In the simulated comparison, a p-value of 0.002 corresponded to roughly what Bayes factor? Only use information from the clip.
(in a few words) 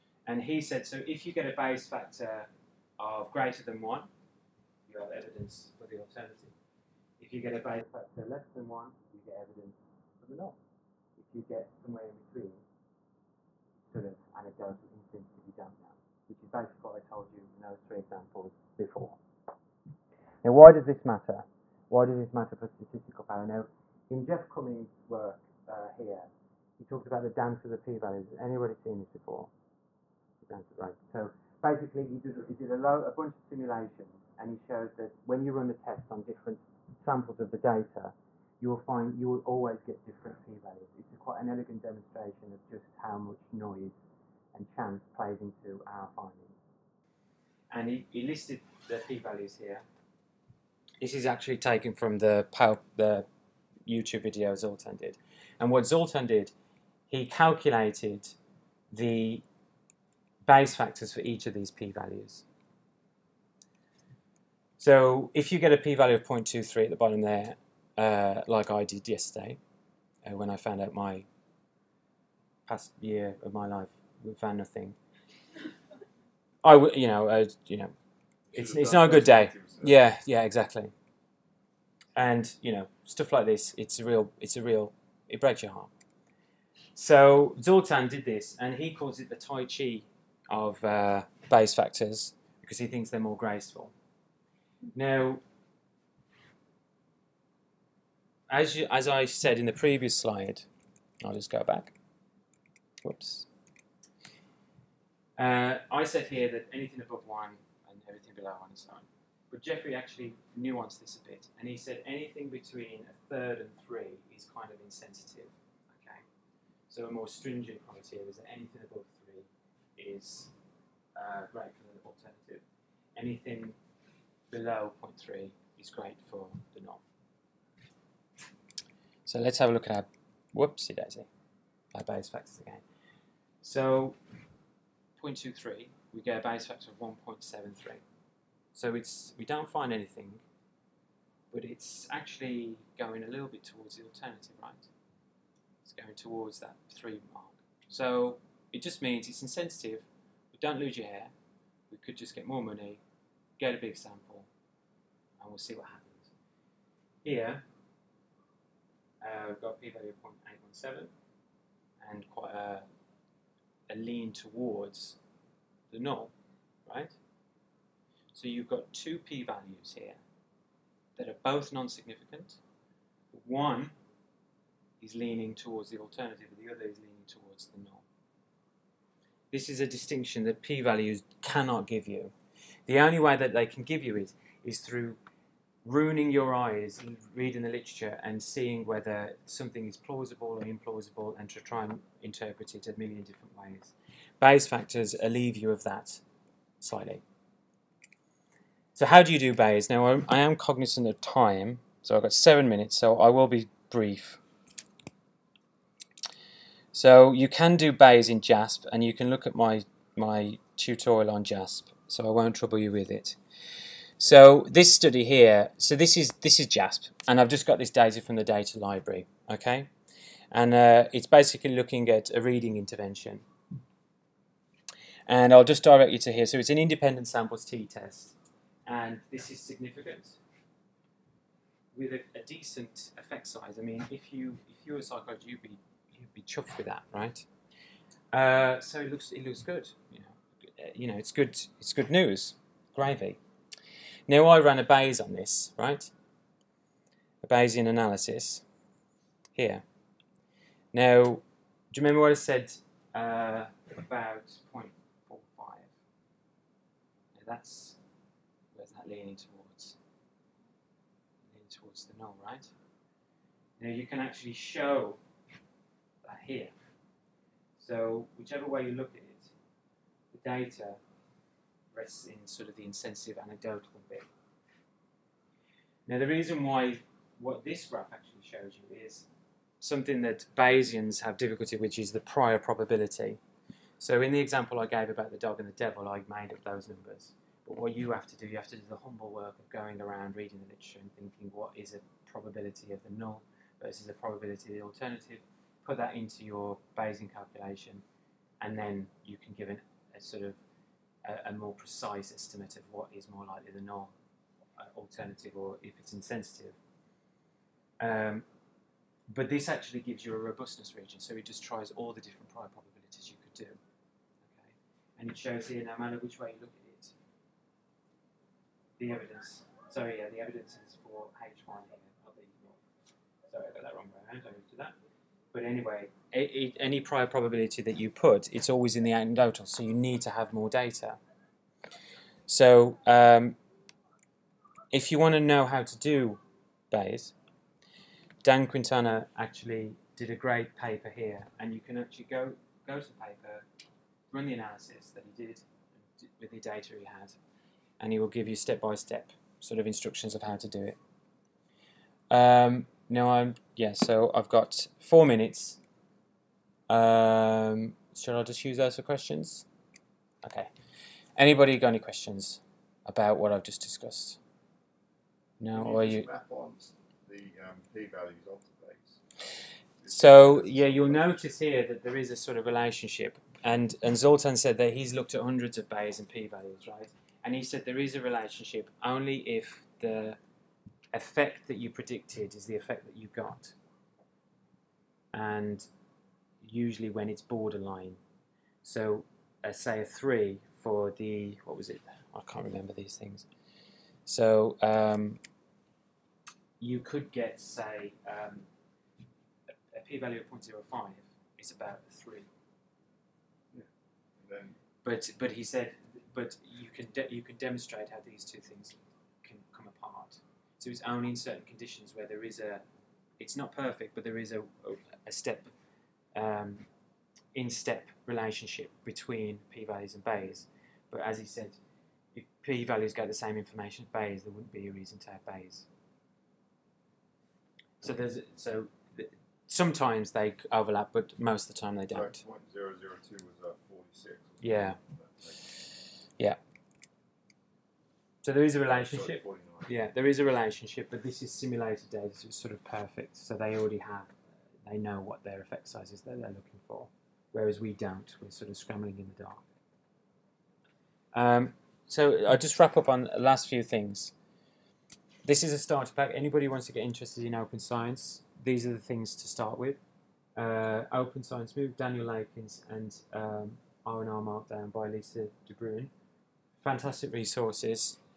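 46.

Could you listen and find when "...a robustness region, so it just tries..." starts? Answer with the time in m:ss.
5:10.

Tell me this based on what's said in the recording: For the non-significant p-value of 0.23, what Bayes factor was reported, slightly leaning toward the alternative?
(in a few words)
1.73.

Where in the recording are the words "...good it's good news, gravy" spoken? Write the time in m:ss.
4:01.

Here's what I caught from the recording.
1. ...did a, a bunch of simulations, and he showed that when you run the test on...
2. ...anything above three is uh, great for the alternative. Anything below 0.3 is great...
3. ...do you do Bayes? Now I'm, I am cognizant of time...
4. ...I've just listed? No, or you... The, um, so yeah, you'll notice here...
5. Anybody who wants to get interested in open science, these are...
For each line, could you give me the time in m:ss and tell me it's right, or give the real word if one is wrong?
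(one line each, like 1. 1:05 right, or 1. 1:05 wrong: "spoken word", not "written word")
1. 0:32 right
2. 1:58 right
3. 3:19 right
4. 6:03 wrong: "discussed", not "listed"
5. 7:36 right.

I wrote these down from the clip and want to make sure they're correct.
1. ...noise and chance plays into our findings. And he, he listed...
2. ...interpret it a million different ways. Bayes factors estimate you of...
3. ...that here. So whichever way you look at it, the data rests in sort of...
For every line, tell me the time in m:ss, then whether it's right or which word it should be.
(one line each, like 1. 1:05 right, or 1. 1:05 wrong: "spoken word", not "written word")
1. 0:43 right
2. 3:12 wrong: "alleviate", not "estimate"
3. 4:26 right.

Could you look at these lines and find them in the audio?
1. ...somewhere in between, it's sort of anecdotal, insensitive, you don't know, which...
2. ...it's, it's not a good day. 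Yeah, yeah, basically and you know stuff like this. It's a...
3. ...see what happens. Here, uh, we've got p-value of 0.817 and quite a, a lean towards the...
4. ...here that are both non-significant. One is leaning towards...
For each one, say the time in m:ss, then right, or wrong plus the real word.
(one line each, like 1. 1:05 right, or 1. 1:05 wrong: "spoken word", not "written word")
1. 0:11 right
2. 1:18 wrong: "exactly", not "basically"
3. 2:35 right
4. 2:49 right.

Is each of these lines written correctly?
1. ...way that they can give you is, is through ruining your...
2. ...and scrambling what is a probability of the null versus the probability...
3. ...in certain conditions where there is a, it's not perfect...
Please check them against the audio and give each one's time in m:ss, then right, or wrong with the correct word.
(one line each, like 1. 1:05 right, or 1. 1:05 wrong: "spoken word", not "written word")
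1. 3:03 right
2. 4:51 wrong: "thinking", not "scrambling"
3. 6:51 right.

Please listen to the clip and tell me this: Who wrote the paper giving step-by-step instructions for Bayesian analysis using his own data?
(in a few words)
Dan Quintana.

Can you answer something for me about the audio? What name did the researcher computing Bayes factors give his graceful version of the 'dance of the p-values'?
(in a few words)
Tai Chi.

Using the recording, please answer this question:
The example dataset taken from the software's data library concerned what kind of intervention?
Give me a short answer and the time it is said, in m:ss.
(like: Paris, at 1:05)
reading intervention, at 3:42.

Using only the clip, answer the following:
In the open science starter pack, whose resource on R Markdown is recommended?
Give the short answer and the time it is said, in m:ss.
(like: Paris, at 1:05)
Lisa DeBruine, at 7:45.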